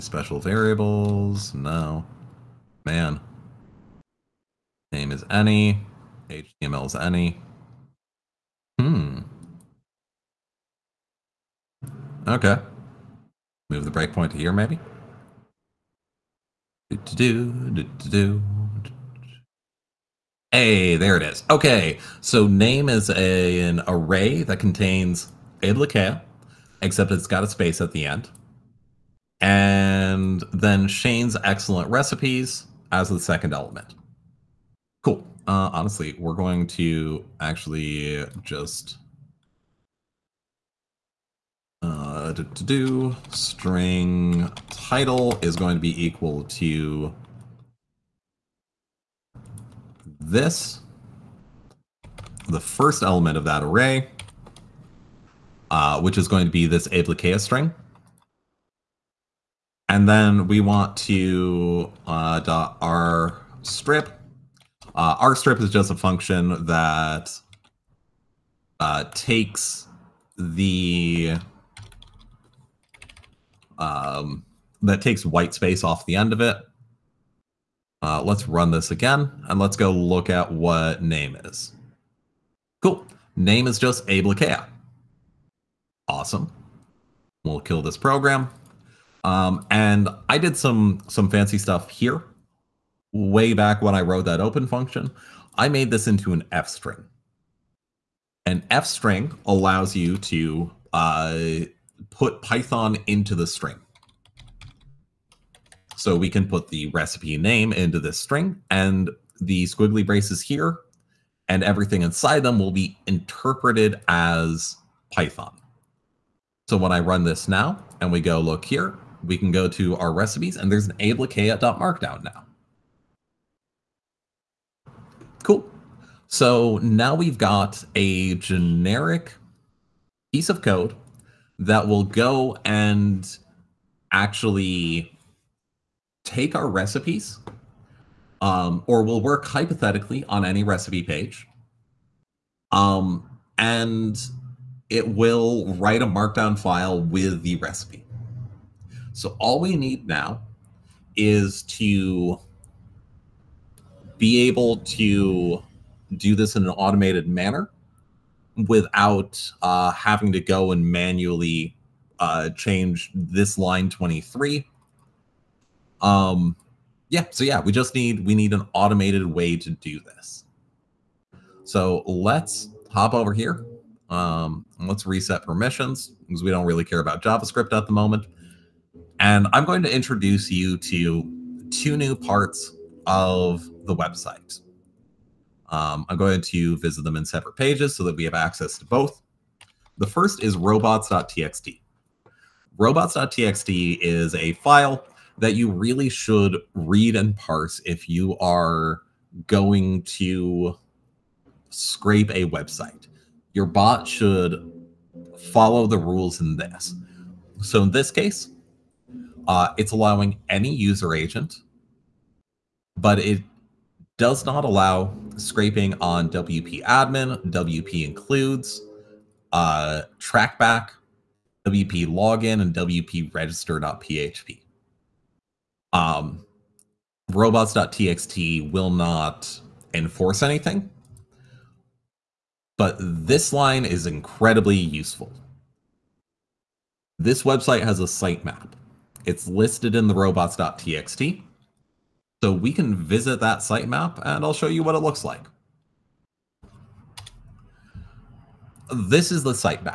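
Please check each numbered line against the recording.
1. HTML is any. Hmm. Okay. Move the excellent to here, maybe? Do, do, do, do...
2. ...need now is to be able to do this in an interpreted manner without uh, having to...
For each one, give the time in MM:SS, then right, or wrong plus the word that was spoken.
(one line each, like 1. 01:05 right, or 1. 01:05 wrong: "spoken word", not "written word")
1. 00:06 wrong: "breakpoint", not "excellent"
2. 02:29 wrong: "automated", not "interpreted".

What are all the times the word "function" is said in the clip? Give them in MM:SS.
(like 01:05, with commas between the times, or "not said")
01:05, 01:34.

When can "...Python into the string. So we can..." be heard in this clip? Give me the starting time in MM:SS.
01:42.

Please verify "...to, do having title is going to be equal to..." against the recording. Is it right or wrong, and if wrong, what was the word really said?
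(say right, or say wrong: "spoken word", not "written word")
wrong: "string", not "having".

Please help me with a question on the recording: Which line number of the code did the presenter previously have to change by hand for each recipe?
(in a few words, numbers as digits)
23.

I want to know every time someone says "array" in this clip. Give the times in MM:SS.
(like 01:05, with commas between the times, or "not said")
00:23, 00:53.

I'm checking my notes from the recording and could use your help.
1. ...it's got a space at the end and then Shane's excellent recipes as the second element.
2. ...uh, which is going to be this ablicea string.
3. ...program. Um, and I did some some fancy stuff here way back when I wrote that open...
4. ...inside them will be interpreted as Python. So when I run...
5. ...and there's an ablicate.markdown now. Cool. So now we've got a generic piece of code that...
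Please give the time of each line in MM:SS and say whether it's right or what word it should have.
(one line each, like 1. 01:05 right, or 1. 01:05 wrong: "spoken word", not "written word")
1. 00:27 right
2. 00:55 right
3. 01:27 right
4. 01:52 right
5. 02:00 right.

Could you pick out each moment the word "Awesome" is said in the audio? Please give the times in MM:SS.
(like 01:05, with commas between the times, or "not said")
01:26.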